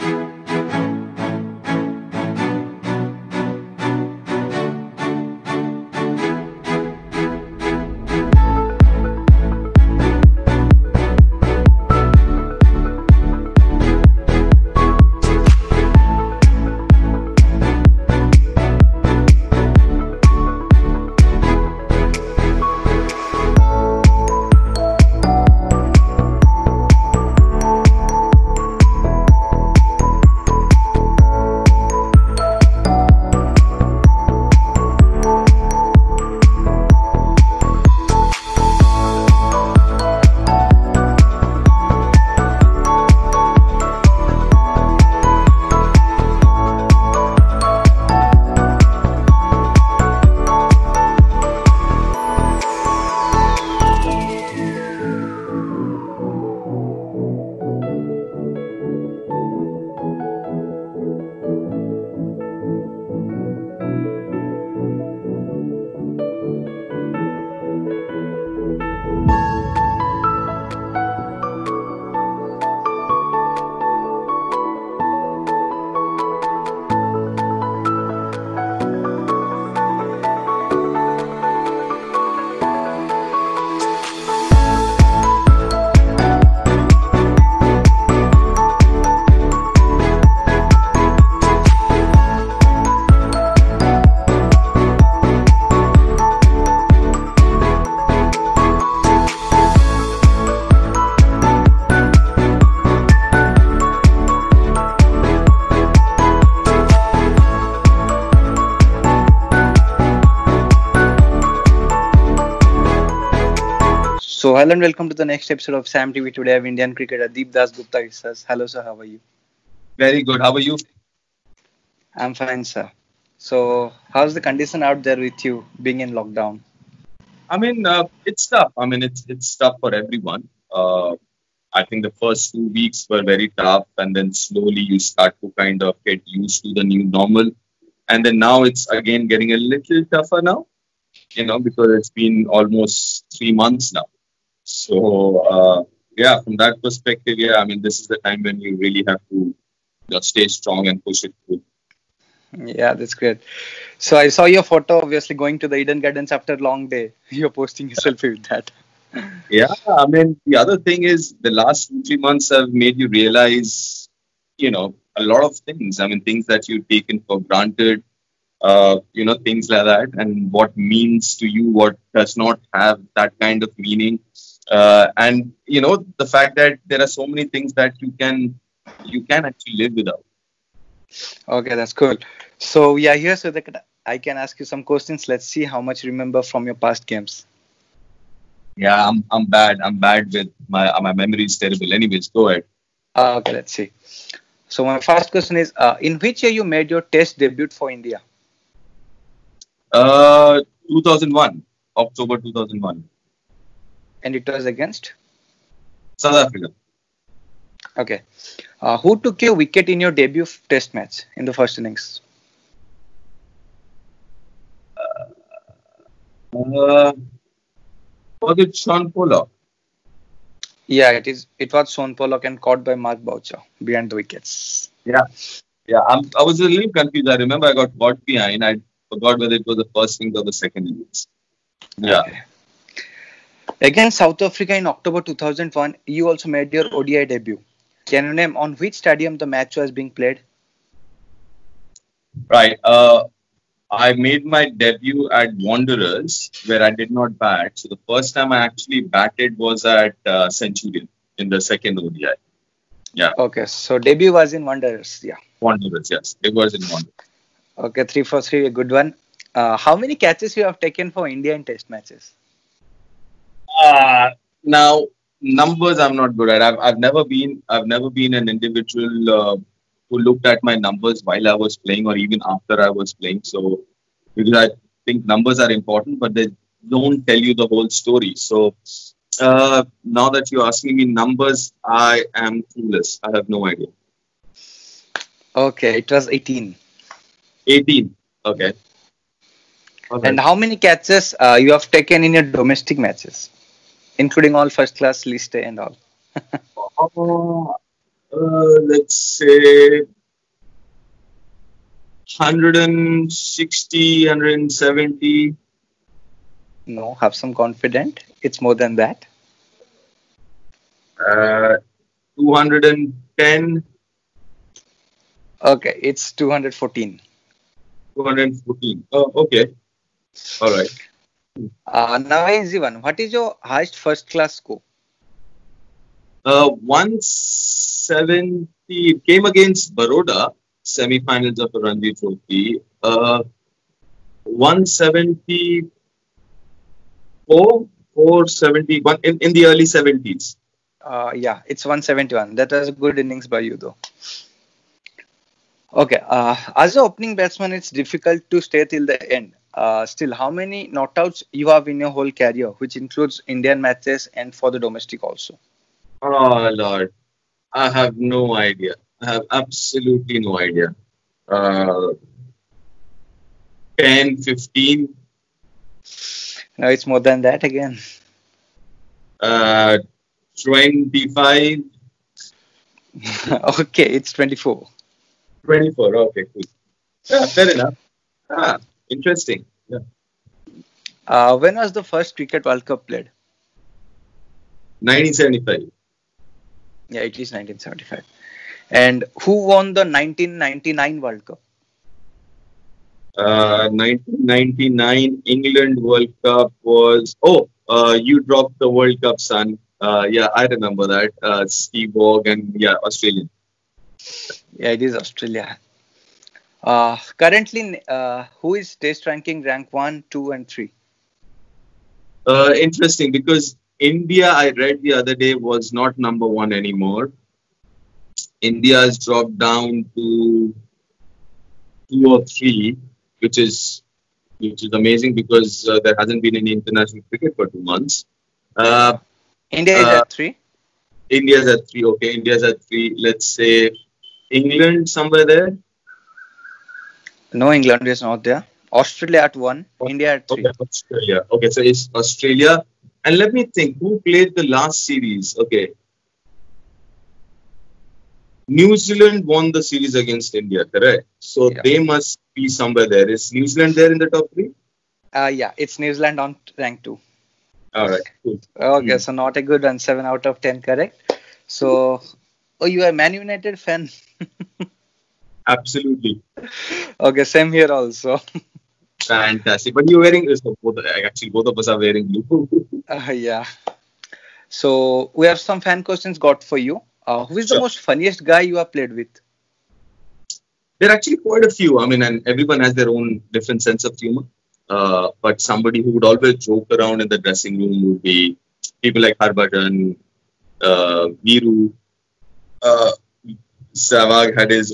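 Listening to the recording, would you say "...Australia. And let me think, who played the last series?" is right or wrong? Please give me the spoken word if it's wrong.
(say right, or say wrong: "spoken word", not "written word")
right.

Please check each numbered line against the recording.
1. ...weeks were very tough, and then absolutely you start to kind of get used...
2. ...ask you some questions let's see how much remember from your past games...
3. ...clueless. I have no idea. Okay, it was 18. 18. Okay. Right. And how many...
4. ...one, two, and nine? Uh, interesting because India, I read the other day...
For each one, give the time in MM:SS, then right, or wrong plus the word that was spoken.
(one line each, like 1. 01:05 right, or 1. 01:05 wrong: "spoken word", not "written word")
1. 02:12 wrong: "slowly", not "absolutely"
2. 03:04 right
3. 04:42 right
4. 06:49 wrong: "three", not "nine".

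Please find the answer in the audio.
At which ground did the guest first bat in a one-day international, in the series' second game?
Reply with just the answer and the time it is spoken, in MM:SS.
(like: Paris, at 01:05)
Centurion, at 04:10.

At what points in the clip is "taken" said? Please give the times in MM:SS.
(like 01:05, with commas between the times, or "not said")
02:46, 04:20, 04:51.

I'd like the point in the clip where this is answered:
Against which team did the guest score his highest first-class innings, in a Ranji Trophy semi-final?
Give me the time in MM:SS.
05:29.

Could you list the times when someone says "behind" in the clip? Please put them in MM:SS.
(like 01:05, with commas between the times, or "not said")
03:43, 03:48.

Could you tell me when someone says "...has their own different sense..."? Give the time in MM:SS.
08:02.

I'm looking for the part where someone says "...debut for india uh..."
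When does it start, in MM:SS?
03:17.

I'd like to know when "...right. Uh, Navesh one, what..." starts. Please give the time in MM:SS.
05:20.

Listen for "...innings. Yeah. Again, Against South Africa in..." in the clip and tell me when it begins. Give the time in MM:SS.
03:50.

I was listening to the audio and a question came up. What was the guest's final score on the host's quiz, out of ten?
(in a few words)
7.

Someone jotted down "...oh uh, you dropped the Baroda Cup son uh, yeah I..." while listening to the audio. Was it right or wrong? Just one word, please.
wrong.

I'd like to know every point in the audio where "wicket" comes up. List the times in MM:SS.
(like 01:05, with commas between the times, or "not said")
03:29, 03:44.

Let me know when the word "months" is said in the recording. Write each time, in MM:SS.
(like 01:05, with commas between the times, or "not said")
02:23, 02:42, 07:07.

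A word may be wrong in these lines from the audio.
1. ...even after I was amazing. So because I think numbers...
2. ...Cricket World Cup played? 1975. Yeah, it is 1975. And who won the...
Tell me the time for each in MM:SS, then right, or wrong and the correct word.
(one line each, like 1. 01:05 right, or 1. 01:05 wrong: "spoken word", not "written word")
1. 04:32 wrong: "playing", not "amazing"
2. 06:22 right.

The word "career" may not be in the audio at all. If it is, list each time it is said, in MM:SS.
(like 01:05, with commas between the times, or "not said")
05:52.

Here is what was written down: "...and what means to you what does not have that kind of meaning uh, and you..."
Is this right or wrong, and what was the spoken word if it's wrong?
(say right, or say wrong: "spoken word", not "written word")
right.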